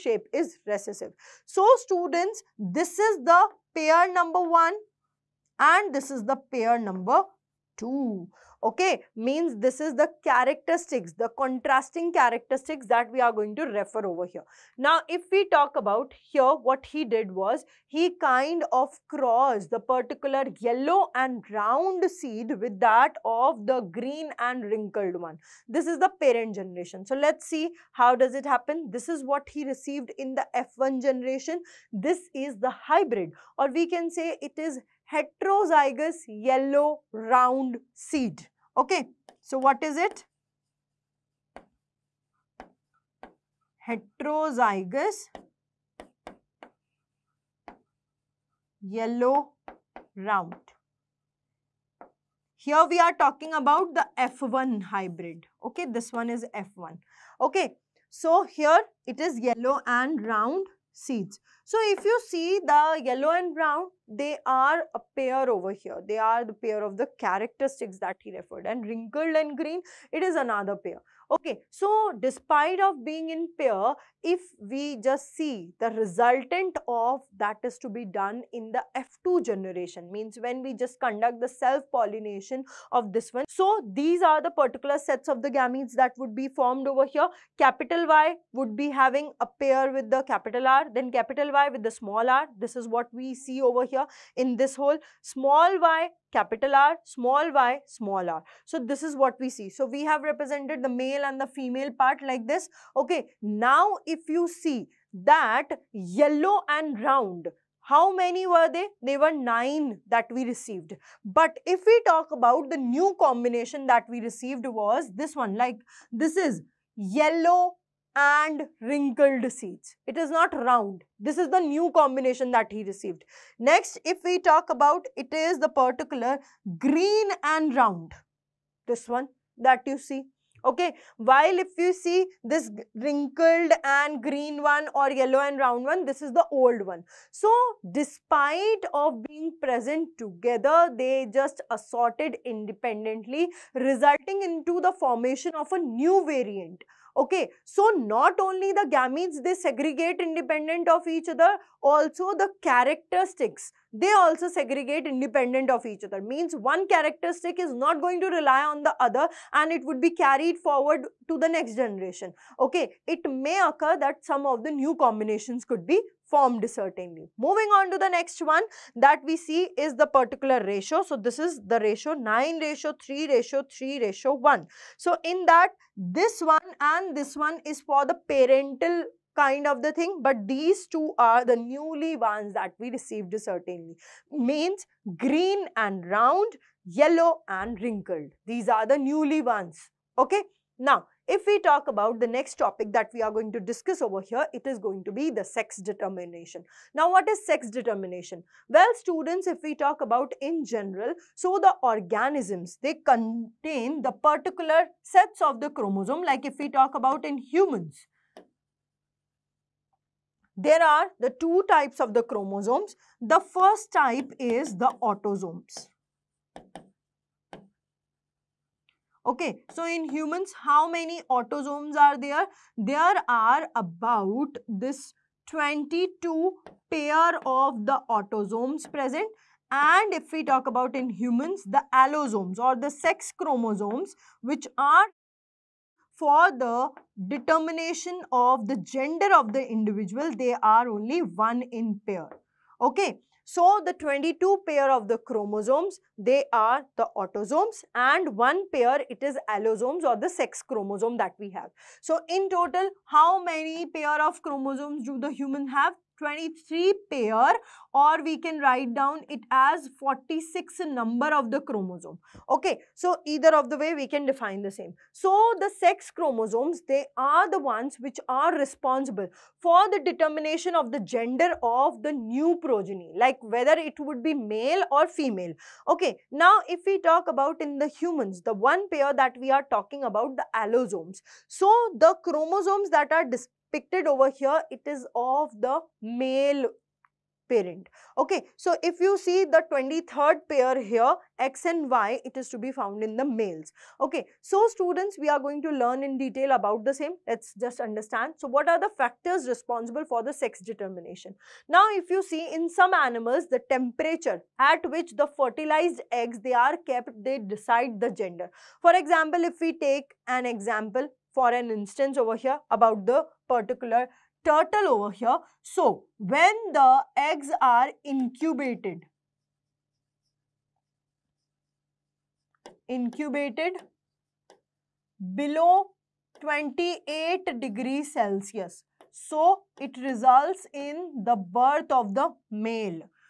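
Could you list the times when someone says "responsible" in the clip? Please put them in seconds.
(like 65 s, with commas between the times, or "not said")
268 s, 299 s.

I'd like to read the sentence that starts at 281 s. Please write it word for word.
So the chromosomes that are dis depicted over here, it is of the male parent.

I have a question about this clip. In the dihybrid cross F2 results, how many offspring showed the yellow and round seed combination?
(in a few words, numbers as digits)
9.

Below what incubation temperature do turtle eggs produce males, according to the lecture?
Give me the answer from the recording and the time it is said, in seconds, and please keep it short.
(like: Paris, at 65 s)
28 degrees Celsius, at 326 s.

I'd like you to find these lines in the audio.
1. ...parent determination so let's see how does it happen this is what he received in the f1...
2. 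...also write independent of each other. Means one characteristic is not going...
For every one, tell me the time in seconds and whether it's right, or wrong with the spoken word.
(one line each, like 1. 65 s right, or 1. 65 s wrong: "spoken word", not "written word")
1. 26 s wrong: "generation", not "determination"
2. 154 s wrong: "segregate", not "write".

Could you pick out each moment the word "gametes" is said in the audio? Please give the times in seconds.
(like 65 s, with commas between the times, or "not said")
85 s, 148 s.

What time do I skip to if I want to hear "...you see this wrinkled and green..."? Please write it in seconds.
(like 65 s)
131 s.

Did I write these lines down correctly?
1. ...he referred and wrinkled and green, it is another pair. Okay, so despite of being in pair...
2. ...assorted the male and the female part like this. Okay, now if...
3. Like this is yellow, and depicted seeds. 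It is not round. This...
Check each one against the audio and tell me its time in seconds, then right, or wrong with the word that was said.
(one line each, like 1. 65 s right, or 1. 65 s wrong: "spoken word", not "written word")
1. 68 s right
2. 100 s wrong: "represented", not "assorted"
3. 115 s wrong: "wrinkled", not "depicted".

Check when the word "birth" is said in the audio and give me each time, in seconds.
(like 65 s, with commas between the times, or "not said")
331 s.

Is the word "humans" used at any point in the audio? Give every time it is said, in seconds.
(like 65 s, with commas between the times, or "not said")
207 s, 220 s, 231 s, 255 s, 277 s.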